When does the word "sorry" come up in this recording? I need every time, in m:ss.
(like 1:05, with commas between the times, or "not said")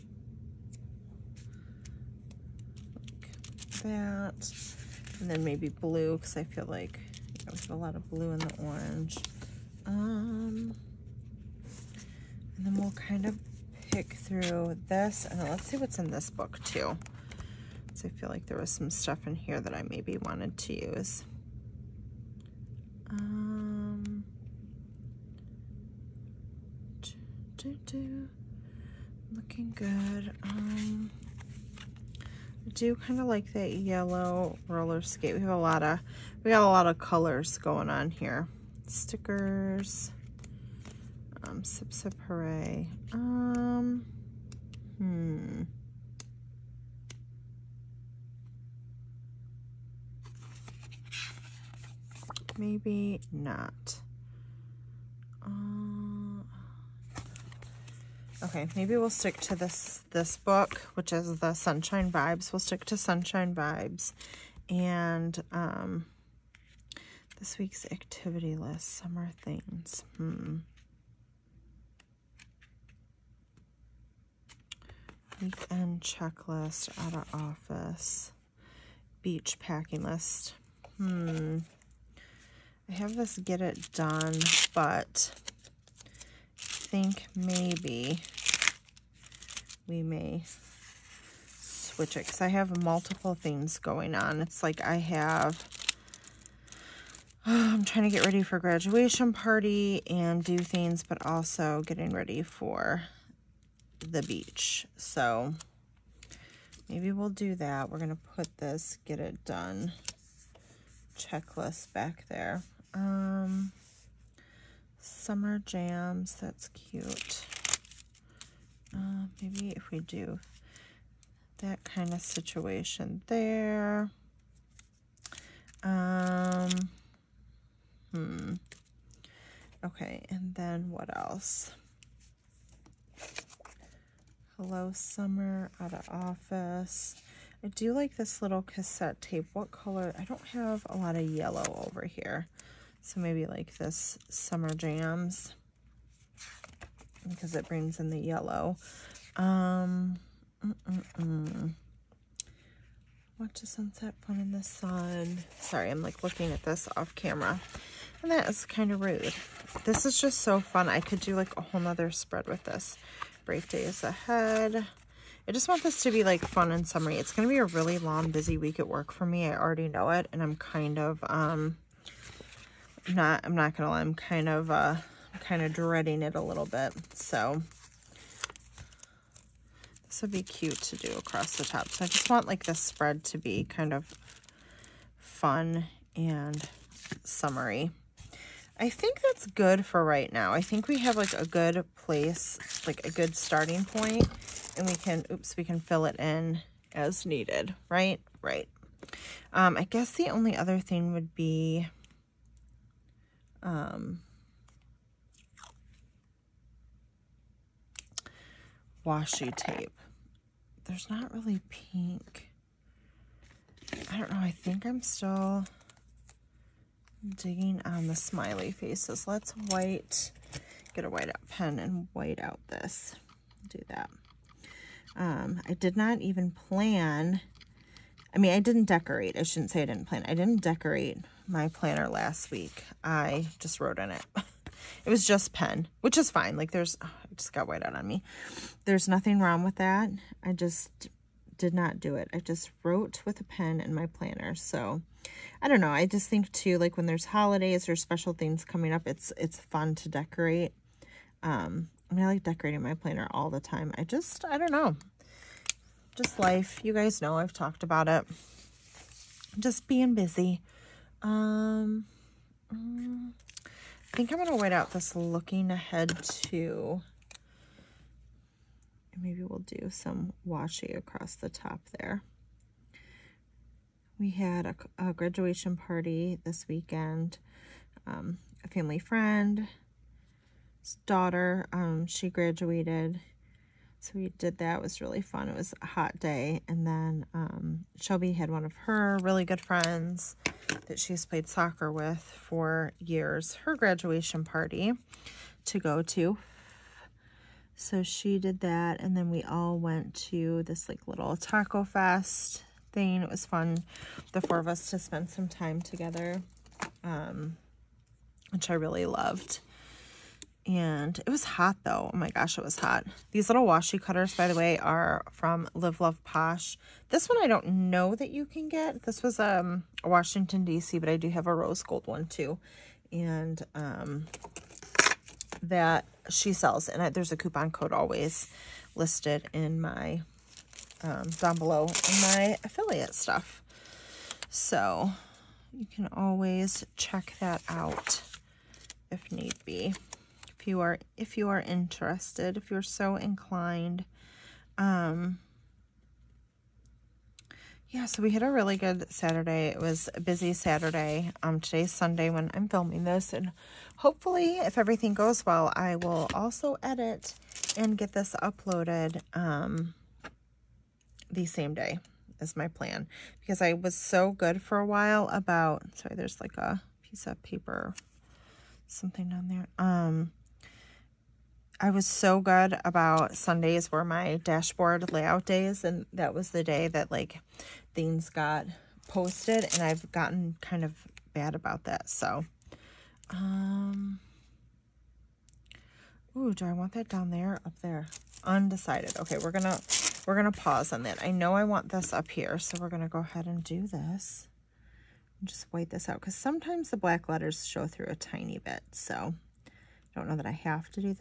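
2:35, 6:05.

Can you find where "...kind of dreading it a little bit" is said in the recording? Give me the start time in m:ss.
2:55.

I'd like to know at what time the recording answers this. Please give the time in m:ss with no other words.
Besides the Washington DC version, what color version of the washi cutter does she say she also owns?
5:21.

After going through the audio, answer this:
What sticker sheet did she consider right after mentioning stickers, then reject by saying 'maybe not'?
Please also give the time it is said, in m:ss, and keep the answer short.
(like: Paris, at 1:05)
Sip Sip Hooray, at 0:41.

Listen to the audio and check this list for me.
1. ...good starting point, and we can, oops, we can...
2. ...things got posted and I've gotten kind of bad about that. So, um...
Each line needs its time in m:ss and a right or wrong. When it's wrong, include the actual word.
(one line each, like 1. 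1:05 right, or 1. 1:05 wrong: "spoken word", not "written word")
1. 3:13 right
2. 6:17 right.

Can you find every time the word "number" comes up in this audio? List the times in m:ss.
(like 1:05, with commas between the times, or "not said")
not said.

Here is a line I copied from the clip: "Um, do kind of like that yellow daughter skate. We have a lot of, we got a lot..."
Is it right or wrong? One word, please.
wrong.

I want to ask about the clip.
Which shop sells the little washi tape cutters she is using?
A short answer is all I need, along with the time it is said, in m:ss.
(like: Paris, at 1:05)
Live Love Posh, at 5:15.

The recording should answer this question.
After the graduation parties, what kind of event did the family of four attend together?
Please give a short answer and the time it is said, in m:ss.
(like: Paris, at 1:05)
taco fest, at 5:01.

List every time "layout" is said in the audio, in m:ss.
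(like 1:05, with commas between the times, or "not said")
6:15.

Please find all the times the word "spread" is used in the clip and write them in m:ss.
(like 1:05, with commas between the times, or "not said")
2:42, 3:02.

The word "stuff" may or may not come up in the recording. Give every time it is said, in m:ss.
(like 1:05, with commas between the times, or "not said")
0:18, 5:33.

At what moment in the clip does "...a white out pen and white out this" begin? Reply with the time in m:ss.
3:41.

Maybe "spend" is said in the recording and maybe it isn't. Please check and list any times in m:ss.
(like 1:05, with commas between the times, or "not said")
5:04.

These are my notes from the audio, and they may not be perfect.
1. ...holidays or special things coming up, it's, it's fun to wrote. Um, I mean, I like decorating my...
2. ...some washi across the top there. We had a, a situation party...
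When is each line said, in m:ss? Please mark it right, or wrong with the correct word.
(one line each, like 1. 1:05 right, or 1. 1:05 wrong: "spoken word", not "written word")
1. 4:07 wrong: "decorate", not "wrote"
2. 4:29 wrong: "graduation", not "situation".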